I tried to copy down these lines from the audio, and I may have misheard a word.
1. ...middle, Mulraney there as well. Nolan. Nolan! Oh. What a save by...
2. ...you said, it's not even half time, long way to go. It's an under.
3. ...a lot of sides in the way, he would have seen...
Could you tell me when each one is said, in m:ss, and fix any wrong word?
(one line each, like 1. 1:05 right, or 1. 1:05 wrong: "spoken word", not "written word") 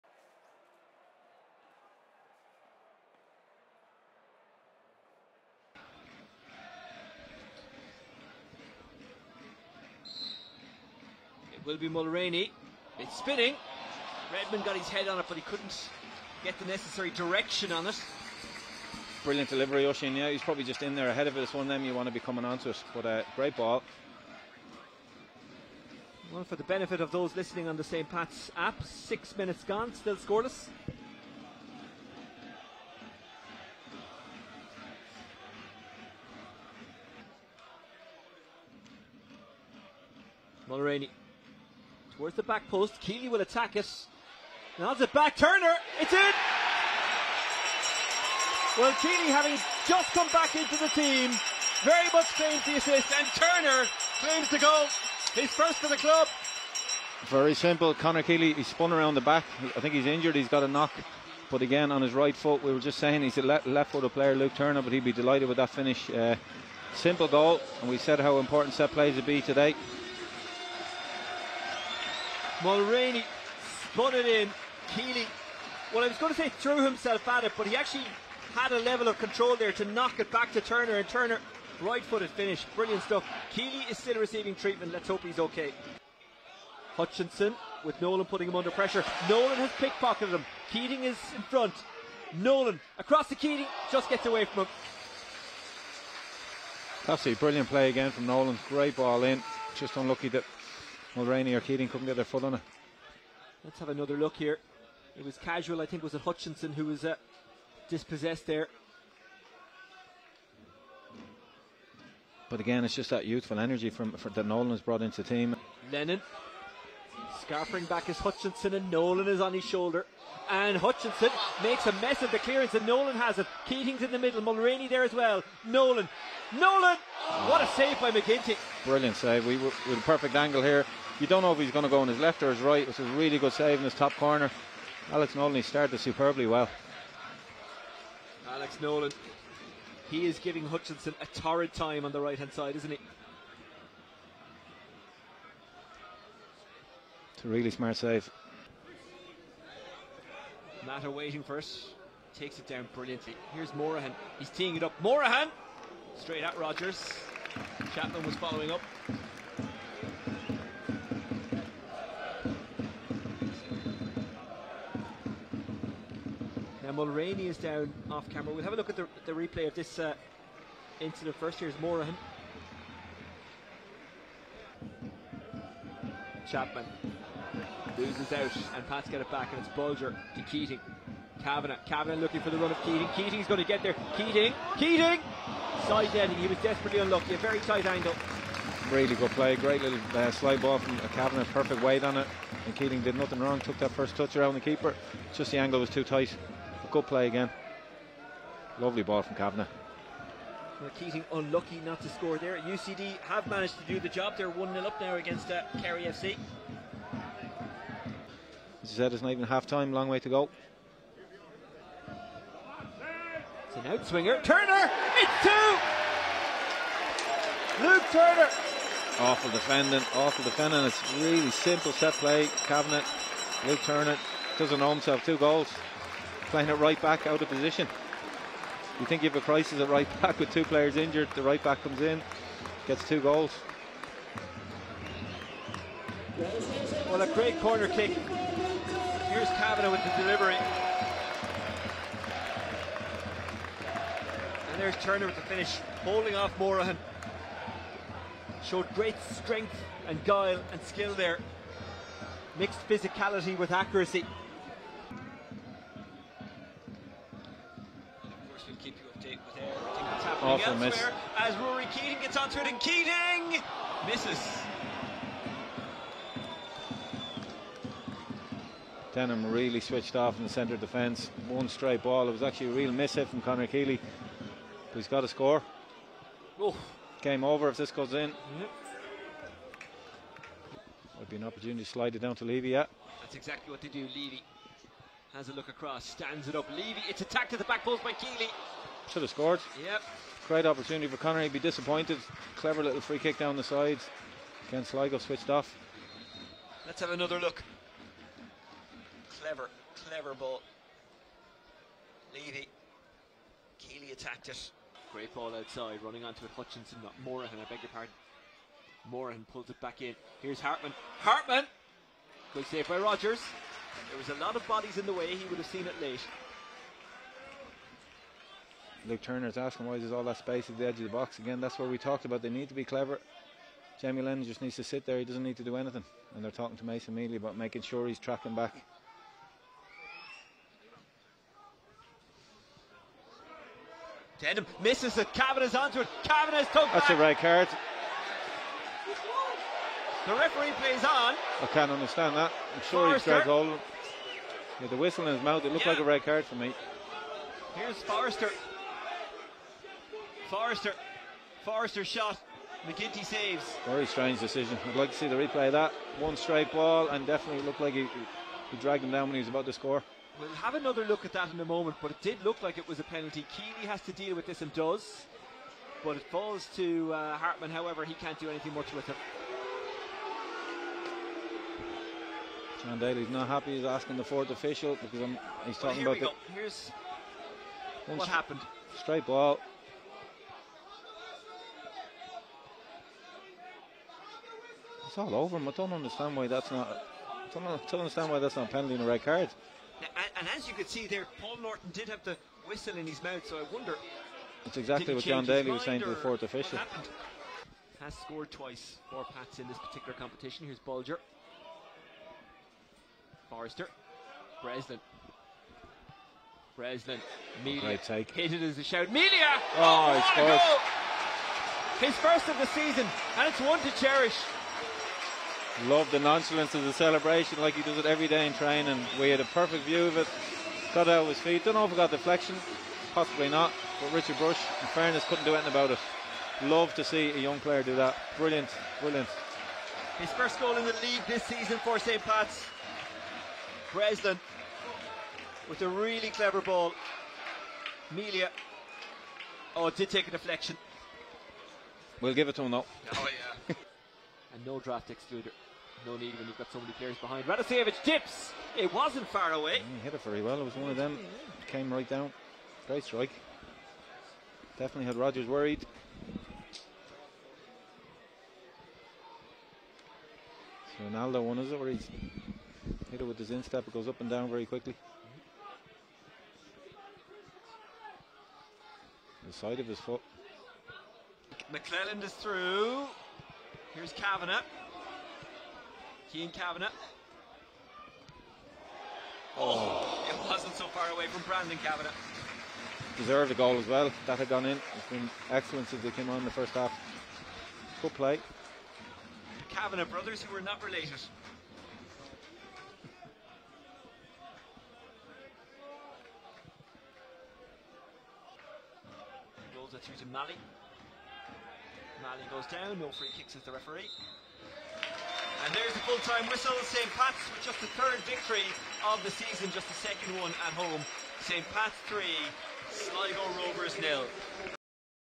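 1. 2:04 right
2. 3:28 wrong: "outswinger", not "under"
3. 5:14 wrong: "bodies", not "sides".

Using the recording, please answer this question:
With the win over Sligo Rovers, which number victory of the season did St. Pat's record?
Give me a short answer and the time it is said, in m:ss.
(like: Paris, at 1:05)
3rd, at 8:27.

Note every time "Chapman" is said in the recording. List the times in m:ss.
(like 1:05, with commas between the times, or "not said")
2:37, 2:56.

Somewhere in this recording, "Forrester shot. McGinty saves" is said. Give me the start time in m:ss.
5:51.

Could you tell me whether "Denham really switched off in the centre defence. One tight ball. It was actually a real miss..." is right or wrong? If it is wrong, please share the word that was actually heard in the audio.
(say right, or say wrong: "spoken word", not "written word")
wrong: "straight", not "tight".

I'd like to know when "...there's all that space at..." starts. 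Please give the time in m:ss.
5:19.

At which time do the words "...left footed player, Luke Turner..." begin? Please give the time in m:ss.
1:03.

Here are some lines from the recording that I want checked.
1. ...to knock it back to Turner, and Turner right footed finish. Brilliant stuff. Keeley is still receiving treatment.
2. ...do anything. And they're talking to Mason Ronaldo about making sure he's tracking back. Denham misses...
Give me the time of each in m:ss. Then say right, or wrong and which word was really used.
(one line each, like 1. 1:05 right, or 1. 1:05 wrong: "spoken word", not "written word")
1. 1:19 right
2. 5:25 wrong: "Melia", not "Ronaldo".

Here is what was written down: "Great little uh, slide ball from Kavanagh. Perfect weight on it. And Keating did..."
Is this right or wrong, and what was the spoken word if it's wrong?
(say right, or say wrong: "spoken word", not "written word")
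right.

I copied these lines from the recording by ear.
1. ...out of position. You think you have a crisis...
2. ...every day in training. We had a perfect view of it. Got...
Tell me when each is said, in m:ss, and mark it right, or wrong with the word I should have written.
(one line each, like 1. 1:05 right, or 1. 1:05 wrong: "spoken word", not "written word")
1. 3:47 right
2. 6:58 right.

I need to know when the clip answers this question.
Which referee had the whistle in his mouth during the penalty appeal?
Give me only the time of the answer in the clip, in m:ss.
6:31.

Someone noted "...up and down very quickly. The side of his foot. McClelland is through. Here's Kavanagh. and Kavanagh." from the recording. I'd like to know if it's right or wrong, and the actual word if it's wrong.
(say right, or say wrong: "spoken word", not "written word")
right.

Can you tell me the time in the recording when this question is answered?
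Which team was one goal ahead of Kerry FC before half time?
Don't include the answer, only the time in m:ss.
3:22.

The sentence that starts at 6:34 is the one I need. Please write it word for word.
It's exactly what John Daly was saying to the fourth official.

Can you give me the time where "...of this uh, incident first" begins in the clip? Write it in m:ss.
2:49.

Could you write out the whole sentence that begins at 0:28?
Pat's app, six minutes gone, still scoreless.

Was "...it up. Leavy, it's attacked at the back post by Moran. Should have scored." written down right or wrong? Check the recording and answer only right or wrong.
wrong.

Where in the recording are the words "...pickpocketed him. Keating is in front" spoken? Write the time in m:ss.
1:29.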